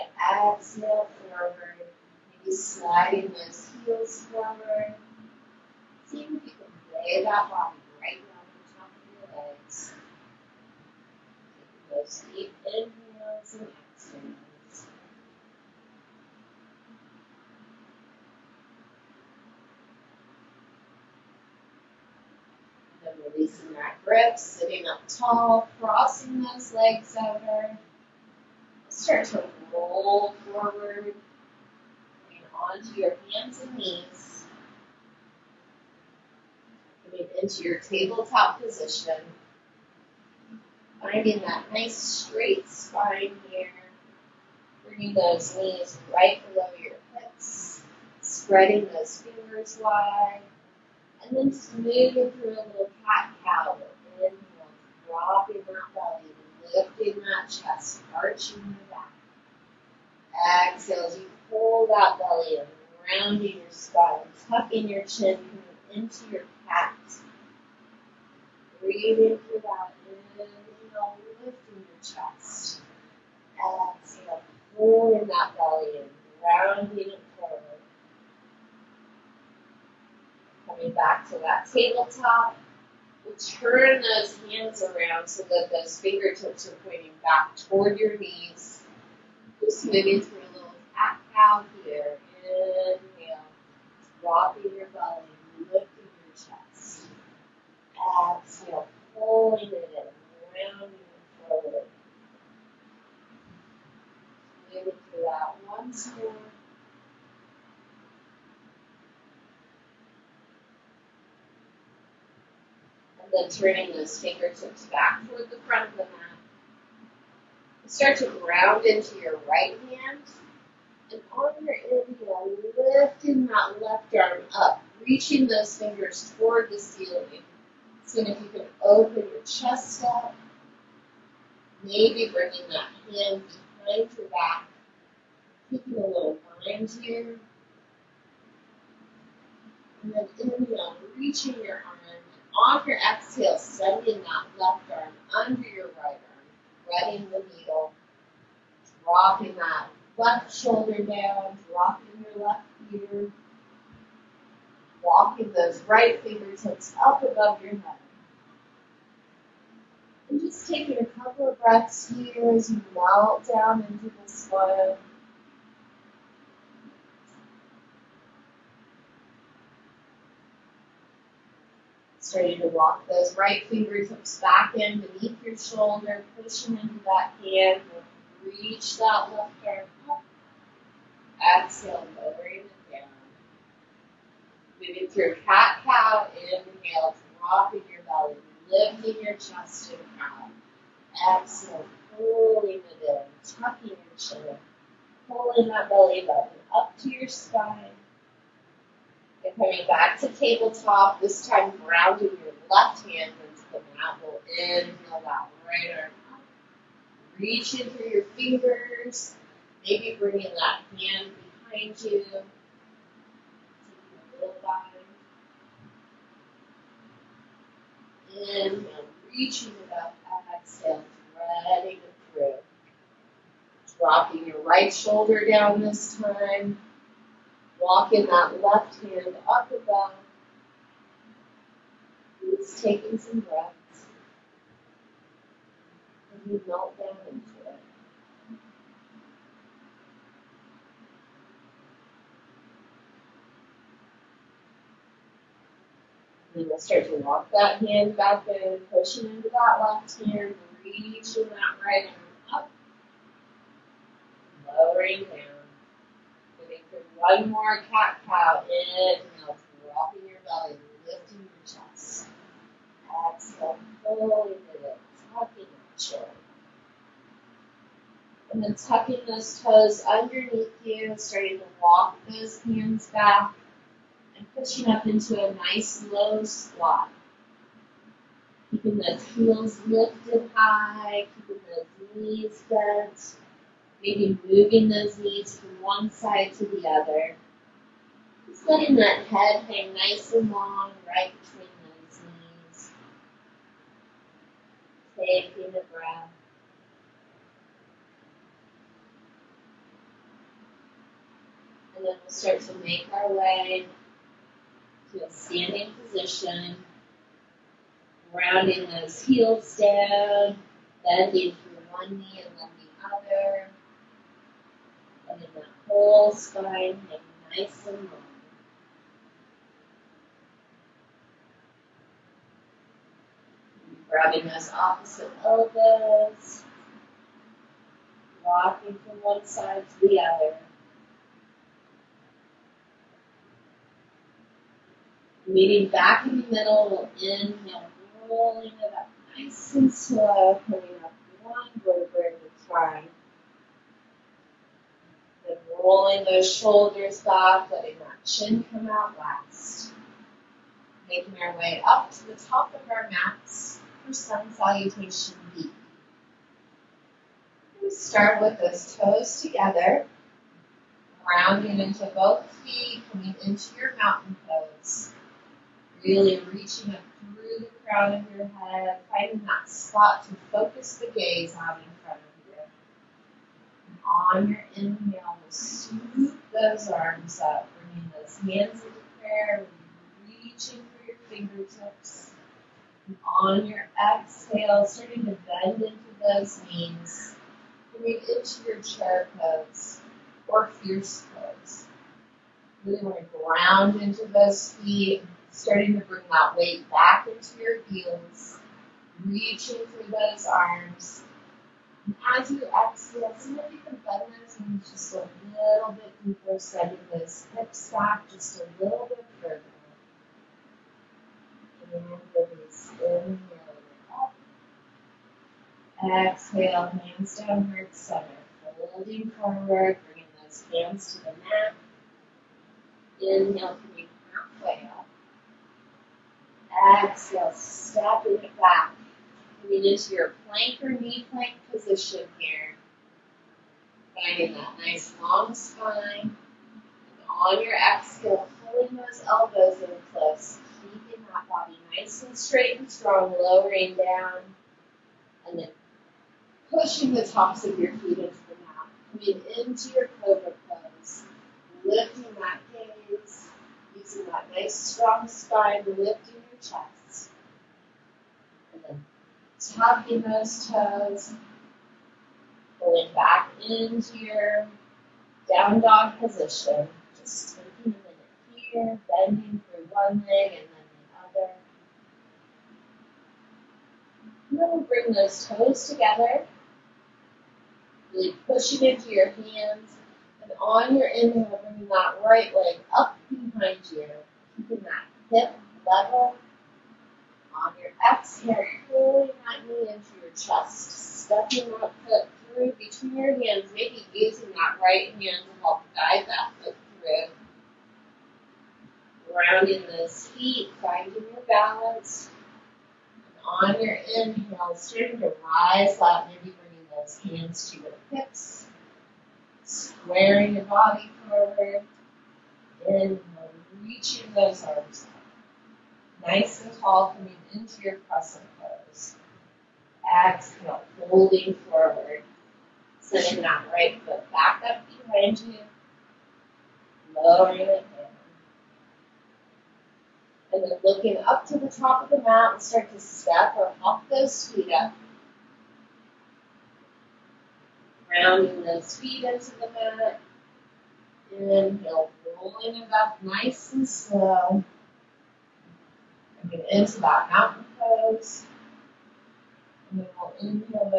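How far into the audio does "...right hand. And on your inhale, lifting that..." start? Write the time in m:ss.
1:59.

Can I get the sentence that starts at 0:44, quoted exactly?
Bringing those knees right below your hips.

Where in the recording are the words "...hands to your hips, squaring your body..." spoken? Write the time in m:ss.
8:27.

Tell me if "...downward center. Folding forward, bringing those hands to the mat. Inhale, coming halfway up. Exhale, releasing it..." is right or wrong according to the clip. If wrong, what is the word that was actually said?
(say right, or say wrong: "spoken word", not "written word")
wrong: "stepping", not "releasing".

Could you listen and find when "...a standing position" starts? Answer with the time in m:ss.
5:05.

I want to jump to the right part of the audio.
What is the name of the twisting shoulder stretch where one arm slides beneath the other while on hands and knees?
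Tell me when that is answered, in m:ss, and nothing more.
2:26.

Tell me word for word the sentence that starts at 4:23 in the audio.
Exhale, fully lift, tucking your chin.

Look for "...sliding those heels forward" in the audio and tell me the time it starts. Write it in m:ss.
0:02.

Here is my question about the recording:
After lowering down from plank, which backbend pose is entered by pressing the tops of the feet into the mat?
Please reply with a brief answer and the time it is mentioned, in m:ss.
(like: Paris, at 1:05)
Cobra pose, at 7:30.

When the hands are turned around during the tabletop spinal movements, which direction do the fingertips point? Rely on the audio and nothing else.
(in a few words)
Toward your knees.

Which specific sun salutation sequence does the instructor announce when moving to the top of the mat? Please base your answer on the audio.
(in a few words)
Sun Salutation B.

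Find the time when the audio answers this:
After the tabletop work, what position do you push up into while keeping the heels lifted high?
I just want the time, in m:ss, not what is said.
4:36.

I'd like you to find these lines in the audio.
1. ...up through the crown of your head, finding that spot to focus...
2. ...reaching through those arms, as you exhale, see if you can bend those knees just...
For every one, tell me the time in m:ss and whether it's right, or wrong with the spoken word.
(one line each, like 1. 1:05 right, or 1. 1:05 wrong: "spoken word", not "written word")
1. 6:06 right
2. 6:39 right.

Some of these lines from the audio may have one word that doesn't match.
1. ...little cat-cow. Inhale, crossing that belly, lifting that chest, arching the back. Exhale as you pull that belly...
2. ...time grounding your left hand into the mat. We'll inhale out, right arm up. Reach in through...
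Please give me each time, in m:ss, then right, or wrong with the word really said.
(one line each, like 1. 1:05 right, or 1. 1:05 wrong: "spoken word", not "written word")
1. 0:52 wrong: "dropping", not "crossing"
2. 3:21 right.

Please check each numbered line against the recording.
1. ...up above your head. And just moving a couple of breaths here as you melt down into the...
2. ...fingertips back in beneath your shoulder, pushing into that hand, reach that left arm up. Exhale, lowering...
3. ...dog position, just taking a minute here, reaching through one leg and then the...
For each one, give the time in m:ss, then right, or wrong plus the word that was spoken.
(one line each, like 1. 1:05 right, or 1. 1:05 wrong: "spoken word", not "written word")
1. 2:37 wrong: "taking", not "moving"
2. 2:53 right
3. 7:45 wrong: "bending", not "reaching".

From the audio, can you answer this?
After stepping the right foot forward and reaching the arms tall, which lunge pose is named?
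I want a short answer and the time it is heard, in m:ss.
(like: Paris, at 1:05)
Crescent pose, at 8:38.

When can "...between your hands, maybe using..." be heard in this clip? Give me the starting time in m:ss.
8:12.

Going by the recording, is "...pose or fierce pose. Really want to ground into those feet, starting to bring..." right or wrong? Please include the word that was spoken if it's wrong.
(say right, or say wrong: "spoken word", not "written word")
right.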